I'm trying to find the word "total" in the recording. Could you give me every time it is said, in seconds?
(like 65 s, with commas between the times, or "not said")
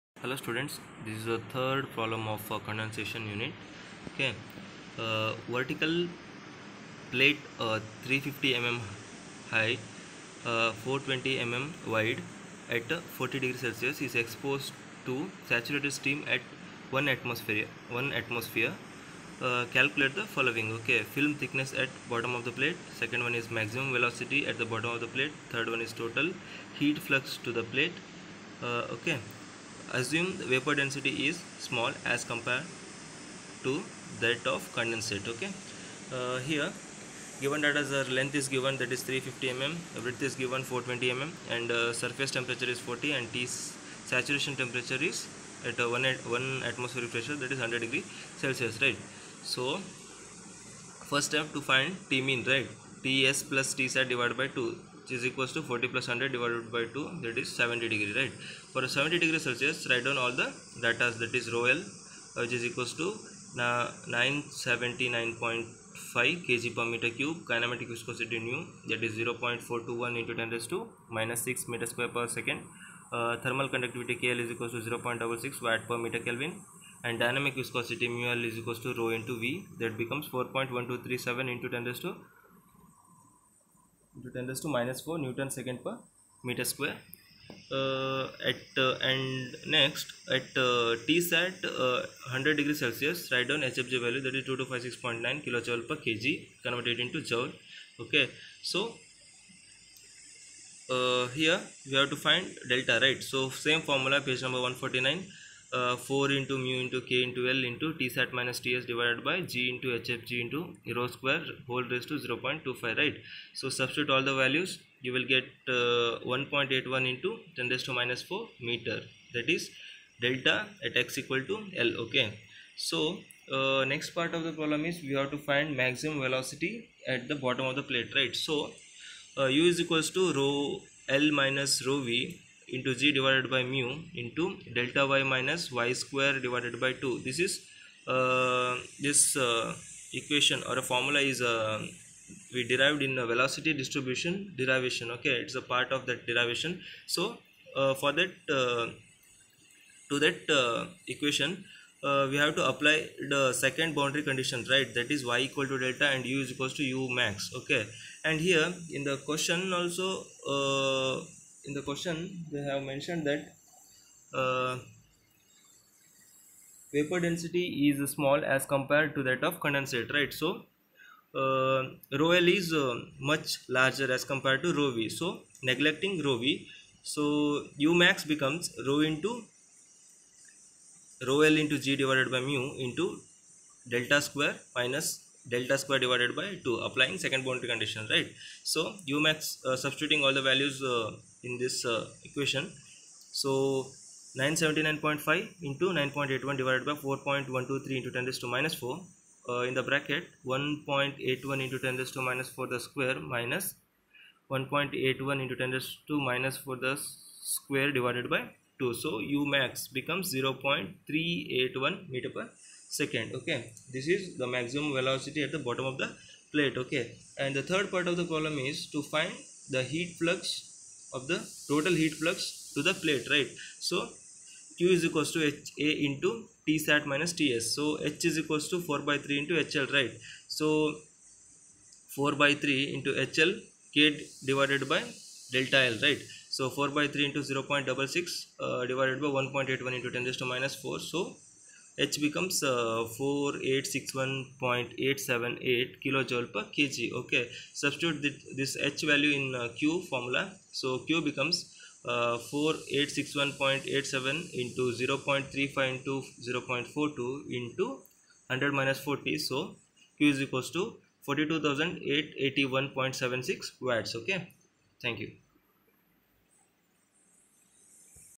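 26 s, 221 s.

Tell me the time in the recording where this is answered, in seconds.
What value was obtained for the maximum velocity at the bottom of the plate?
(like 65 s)
210 s.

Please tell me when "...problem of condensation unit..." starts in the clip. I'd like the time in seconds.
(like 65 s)
1 s.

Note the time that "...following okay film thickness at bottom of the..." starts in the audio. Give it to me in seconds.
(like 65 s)
20 s.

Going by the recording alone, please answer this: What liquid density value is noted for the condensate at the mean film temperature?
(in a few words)
979.5 kg per cubic meter.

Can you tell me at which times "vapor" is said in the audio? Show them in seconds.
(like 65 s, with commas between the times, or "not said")
30 s, 166 s.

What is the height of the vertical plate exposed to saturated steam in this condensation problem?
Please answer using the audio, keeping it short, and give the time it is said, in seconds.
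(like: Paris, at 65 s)
350 mm, at 8 s.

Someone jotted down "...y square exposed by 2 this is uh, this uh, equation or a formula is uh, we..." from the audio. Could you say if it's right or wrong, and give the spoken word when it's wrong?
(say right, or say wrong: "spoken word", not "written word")
wrong: "divided", not "exposed".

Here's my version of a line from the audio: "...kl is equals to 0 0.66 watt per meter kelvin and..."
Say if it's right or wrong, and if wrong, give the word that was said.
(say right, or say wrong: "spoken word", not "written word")
right.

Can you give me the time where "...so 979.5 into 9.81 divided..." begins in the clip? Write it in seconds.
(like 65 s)
193 s.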